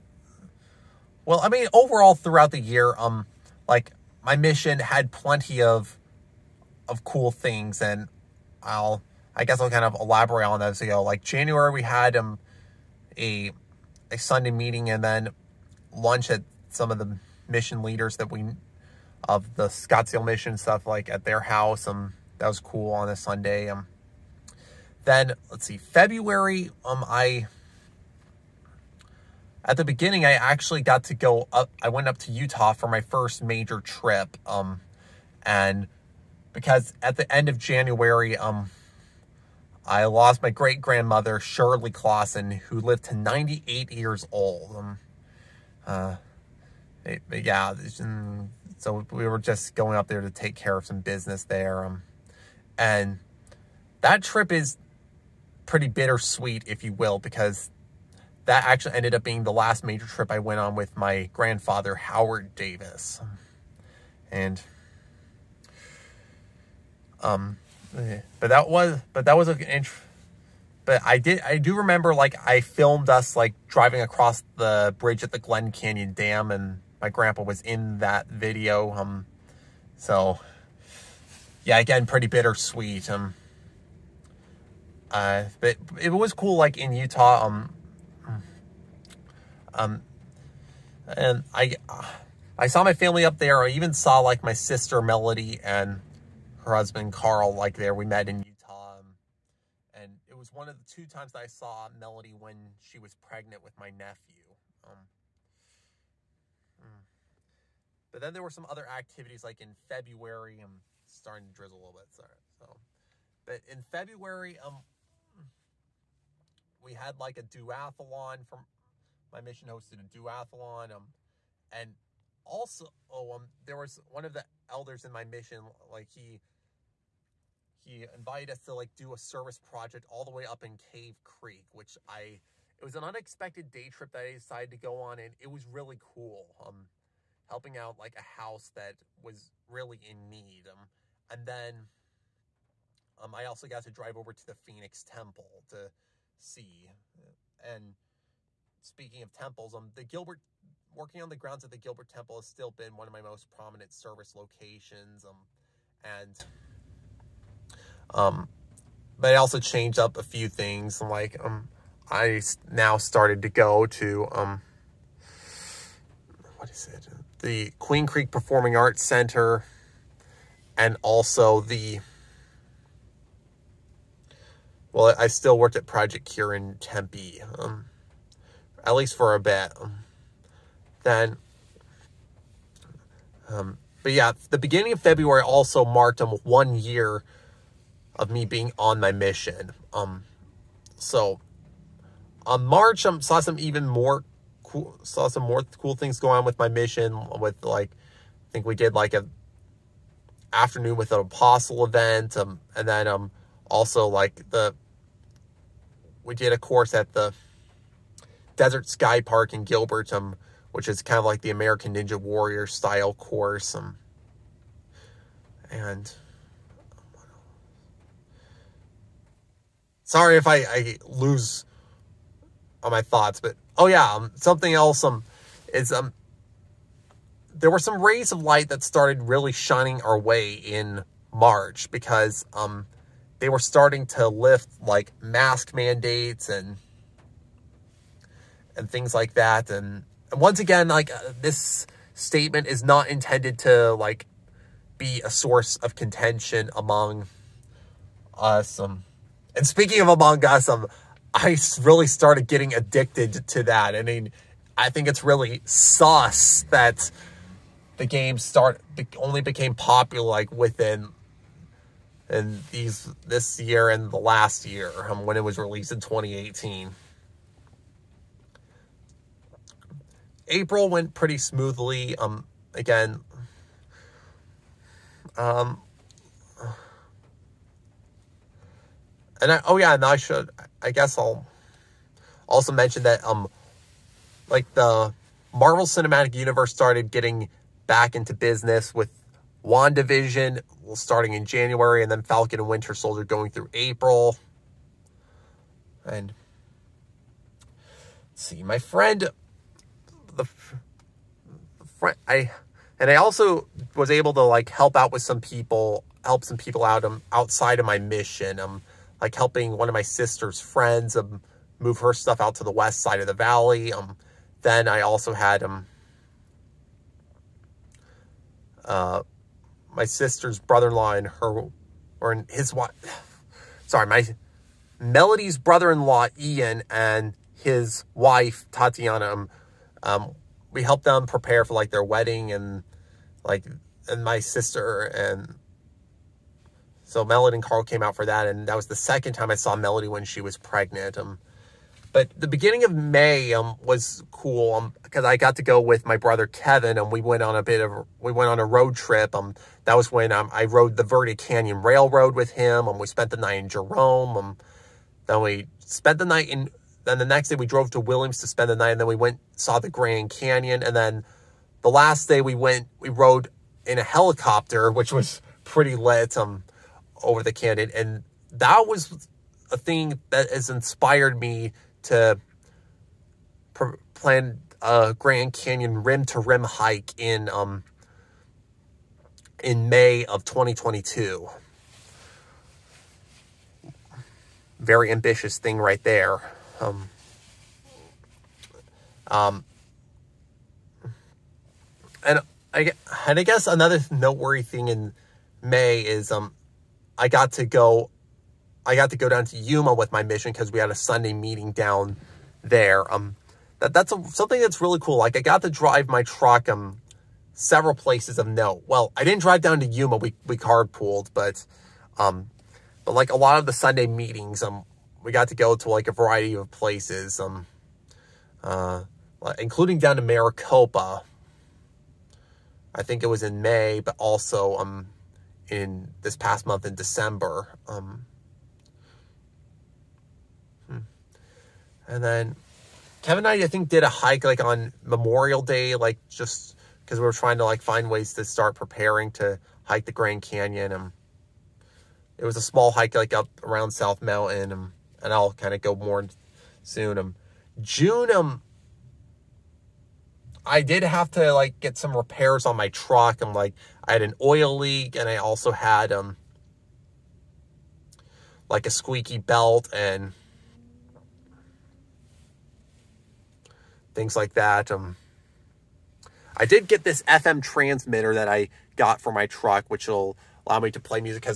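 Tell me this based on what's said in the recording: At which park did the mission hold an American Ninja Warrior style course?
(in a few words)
Desert Sky Park.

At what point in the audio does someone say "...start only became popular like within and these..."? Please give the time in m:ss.
4:18.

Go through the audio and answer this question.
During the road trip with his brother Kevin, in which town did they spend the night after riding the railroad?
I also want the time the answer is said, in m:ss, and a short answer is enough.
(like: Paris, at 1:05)
Jerome, at 5:53.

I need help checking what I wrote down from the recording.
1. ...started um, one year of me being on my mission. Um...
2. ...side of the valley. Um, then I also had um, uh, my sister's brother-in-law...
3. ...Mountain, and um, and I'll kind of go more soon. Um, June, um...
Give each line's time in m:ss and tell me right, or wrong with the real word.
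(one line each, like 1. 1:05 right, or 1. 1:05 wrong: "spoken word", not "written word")
1. 3:05 wrong: "marked", not "started"
2. 5:13 right
3. 7:24 right.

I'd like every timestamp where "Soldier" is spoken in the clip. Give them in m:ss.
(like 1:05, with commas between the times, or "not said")
4:52.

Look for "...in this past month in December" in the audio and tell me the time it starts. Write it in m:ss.
7:05.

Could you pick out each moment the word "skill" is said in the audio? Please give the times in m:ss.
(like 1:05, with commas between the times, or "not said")
not said.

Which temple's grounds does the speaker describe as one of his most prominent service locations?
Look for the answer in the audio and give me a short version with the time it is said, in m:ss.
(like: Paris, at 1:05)
Gilbert Temple, at 2:31.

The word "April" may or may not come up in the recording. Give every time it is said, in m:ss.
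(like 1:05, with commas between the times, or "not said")
4:30, 4:53.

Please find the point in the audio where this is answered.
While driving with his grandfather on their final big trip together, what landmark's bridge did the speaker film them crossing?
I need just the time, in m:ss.
1:15.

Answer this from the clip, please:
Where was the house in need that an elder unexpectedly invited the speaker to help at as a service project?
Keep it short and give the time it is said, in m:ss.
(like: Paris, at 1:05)
Cave Creek, at 2:10.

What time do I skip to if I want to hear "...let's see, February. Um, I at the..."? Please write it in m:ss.
0:25.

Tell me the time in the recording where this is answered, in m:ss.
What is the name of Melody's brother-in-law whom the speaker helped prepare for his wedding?
5:26.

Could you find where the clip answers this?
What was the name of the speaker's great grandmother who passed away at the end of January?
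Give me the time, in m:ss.
0:41.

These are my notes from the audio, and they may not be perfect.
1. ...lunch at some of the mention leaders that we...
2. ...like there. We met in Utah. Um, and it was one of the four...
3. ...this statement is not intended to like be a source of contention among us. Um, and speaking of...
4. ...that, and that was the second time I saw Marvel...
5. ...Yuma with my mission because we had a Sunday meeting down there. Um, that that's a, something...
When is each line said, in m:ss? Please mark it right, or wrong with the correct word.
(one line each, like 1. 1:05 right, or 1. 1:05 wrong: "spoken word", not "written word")
1. 0:15 wrong: "mission", not "mention"
2. 1:37 wrong: "two", not "four"
3. 4:01 right
4. 5:38 wrong: "Melody", not "Marvel"
5. 6:39 right.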